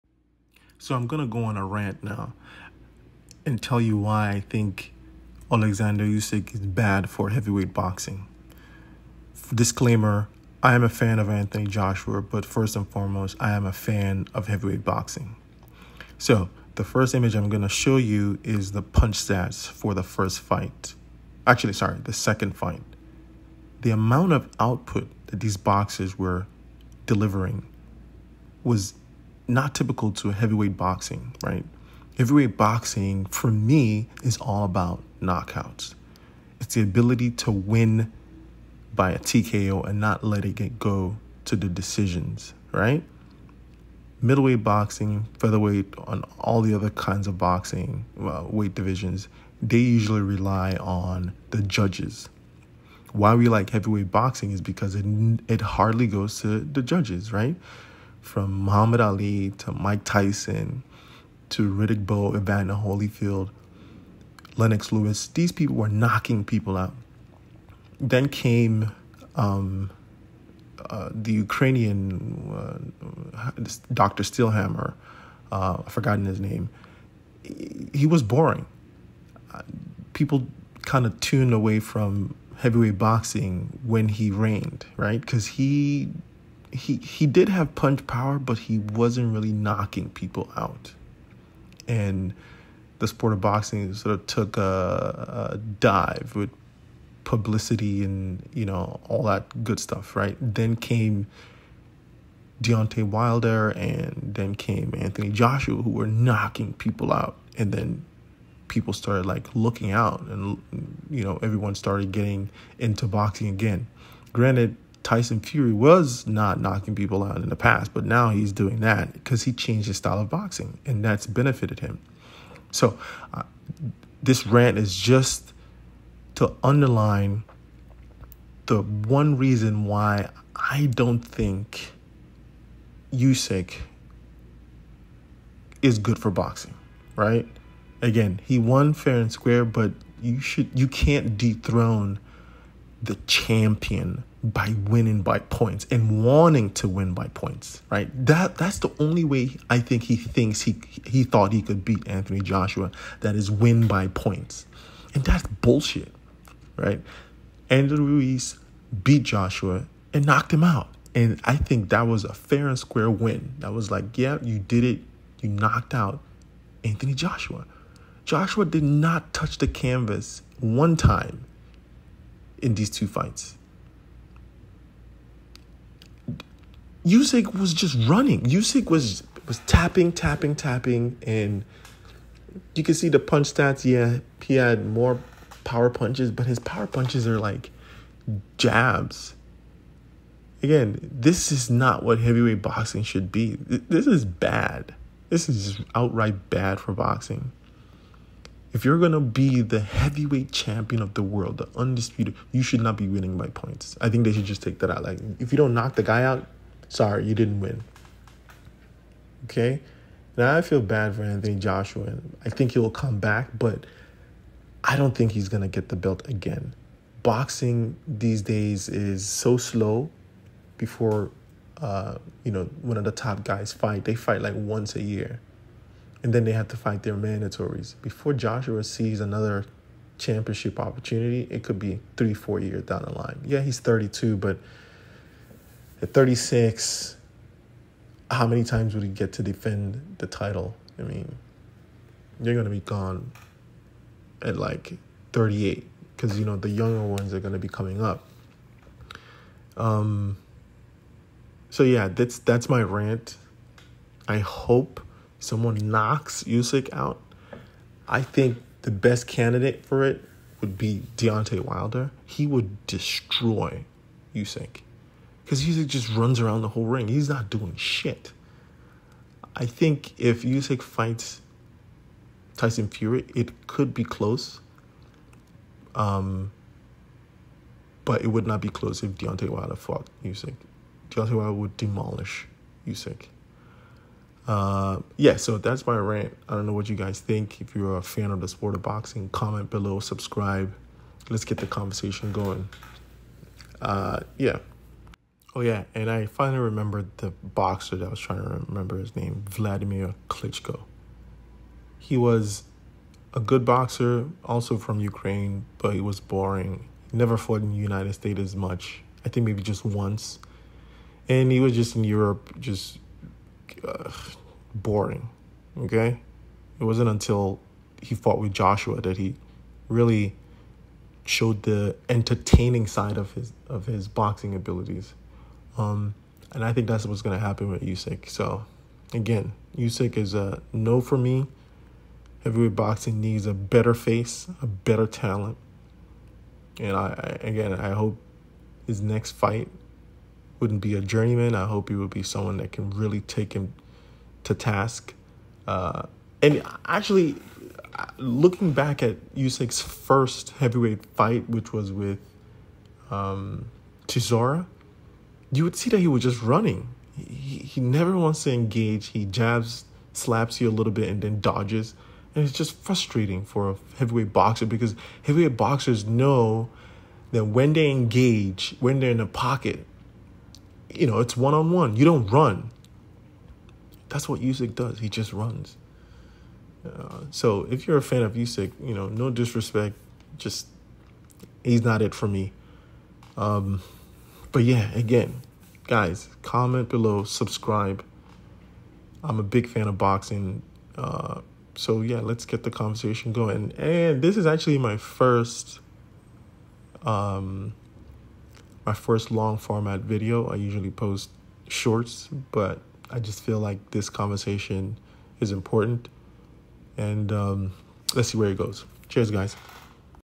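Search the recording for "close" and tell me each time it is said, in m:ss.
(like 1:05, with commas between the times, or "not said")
4:34, 4:38.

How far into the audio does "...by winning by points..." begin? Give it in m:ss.
2:24.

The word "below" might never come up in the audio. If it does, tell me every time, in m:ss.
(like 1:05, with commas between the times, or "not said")
4:49, 6:26.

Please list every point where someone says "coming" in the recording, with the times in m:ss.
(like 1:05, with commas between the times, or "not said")
4:07.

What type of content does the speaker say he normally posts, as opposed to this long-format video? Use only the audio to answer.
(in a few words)
Shorts.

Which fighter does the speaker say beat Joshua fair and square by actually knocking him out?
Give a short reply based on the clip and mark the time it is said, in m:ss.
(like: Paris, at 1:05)
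Andrew Ruiz, at 2:37.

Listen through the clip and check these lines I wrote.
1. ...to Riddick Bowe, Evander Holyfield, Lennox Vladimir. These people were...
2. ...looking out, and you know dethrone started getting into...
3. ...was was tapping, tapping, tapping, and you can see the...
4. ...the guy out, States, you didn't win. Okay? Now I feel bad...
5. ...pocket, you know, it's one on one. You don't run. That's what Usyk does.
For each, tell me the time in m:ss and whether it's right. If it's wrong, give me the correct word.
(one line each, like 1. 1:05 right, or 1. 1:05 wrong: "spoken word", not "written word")
1. 1:01 wrong: "Lewis", not "Vladimir"
2. 1:49 wrong: "everyone", not "dethrone"
3. 2:58 right
4. 3:25 wrong: "Sorry", not "States"
5. 6:09 right.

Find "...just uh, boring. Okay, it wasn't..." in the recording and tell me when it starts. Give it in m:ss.
5:12.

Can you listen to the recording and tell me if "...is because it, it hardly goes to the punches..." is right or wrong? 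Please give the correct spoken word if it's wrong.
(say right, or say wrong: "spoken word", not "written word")
wrong: "judges", not "punches".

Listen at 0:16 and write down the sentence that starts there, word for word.
So, the first image I'm going to show you is the punch stats for the first fight.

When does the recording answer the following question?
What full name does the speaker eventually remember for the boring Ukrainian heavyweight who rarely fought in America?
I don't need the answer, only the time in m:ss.
4:59.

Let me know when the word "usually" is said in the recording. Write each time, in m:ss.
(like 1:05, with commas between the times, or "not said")
0:49, 6:40.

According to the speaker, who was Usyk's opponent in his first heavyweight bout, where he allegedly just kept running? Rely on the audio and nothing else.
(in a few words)
Chisora.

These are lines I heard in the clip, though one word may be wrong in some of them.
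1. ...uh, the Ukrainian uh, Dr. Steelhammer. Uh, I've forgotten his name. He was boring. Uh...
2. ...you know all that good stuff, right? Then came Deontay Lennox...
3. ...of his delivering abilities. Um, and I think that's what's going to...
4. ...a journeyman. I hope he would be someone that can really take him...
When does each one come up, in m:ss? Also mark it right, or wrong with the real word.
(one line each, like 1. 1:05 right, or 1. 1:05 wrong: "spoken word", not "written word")
1. 1:10 right
2. 1:38 wrong: "Wilder", not "Lennox"
3. 5:23 wrong: "boxing", not "delivering"
4. 5:40 right.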